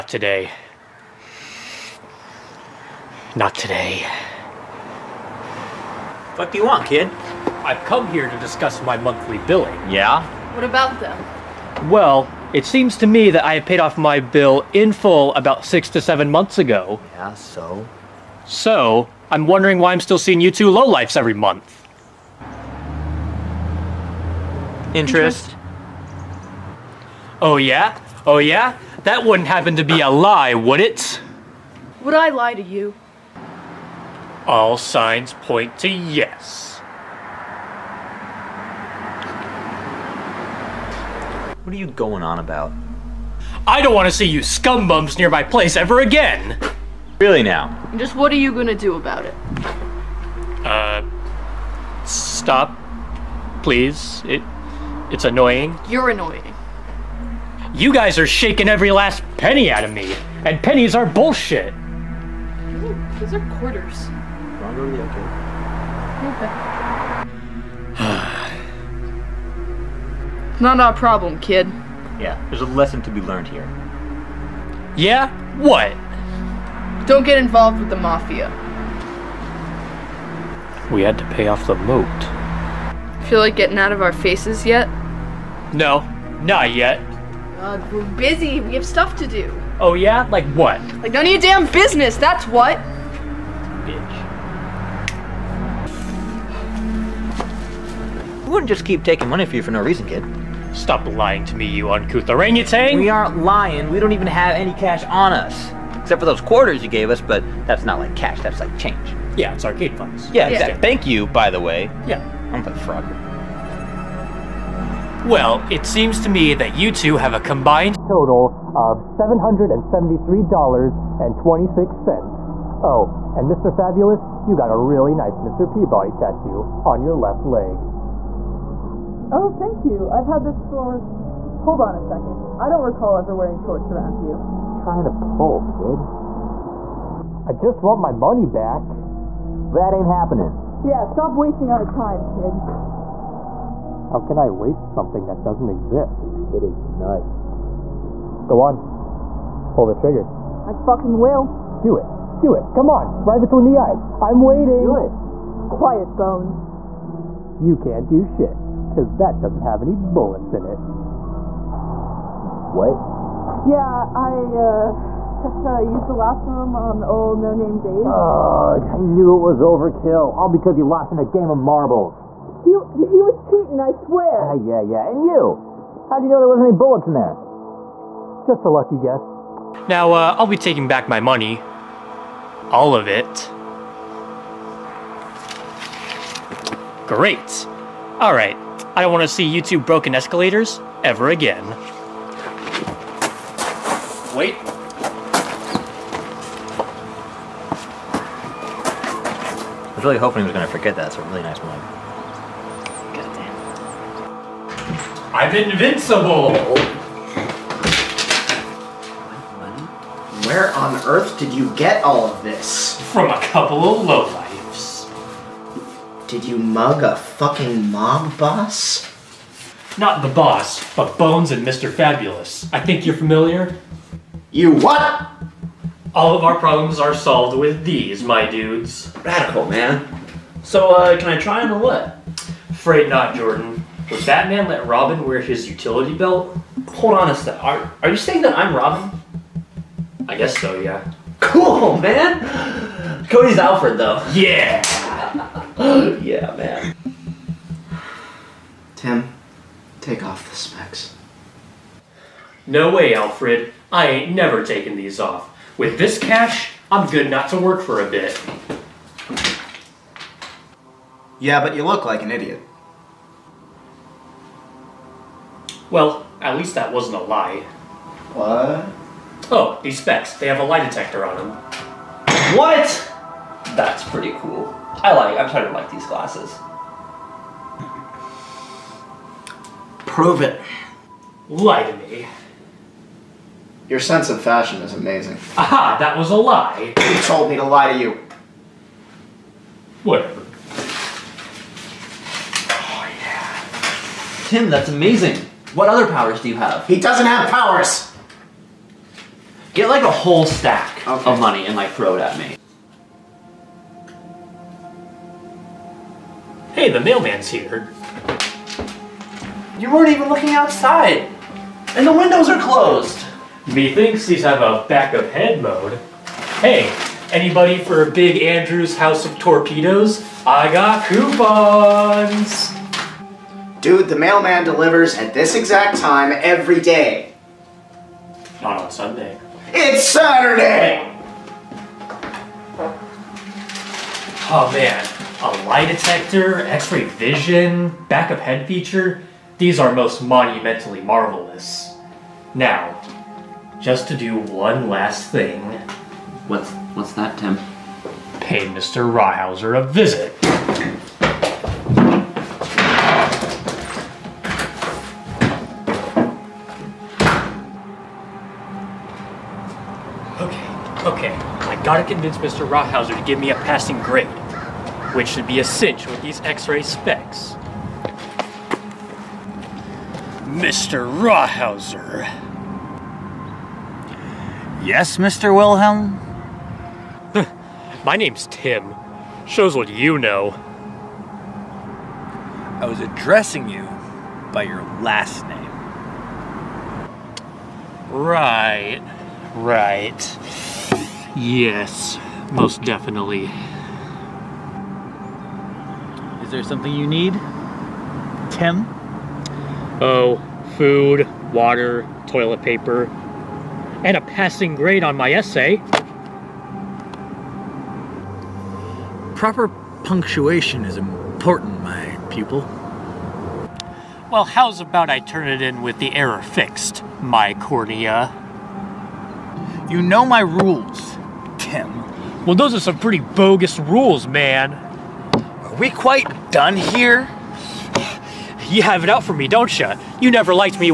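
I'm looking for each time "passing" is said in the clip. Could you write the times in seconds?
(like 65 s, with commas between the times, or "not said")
363 s, 404 s.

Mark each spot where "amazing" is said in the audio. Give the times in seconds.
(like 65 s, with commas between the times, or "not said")
284 s, 294 s.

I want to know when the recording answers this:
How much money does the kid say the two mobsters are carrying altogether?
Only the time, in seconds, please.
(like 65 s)
118 s.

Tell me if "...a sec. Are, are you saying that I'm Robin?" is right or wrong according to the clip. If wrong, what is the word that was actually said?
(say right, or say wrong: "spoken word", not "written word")
right.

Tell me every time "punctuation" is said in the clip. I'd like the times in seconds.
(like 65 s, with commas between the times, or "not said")
410 s.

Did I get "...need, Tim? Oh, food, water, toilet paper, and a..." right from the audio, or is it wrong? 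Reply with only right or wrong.
right.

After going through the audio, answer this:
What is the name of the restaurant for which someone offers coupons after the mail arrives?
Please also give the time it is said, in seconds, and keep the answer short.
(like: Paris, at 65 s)
Big Andrew's House of Torpedoes, at 318 s.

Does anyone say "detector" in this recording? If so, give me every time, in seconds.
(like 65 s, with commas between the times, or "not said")
270 s, 335 s.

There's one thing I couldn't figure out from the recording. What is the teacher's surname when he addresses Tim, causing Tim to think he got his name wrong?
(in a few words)
Wilhelm.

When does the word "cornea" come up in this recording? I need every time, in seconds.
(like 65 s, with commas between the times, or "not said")
417 s.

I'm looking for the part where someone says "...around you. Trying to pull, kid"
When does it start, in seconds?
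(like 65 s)
133 s.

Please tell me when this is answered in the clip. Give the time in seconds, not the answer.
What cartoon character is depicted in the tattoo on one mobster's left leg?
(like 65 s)
125 s.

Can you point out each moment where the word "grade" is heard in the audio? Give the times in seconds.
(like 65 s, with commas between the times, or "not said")
364 s, 404 s.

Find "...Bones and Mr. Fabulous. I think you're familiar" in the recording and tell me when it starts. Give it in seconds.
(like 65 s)
221 s.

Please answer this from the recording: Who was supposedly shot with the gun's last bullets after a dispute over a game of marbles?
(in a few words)
No Name Dave.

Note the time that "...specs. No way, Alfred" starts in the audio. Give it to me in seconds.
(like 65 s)
250 s.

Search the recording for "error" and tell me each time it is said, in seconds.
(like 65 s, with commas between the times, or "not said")
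416 s.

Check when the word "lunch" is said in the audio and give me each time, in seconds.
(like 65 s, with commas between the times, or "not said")
not said.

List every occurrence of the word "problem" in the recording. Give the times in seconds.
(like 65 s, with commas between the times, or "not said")
70 s, 226 s.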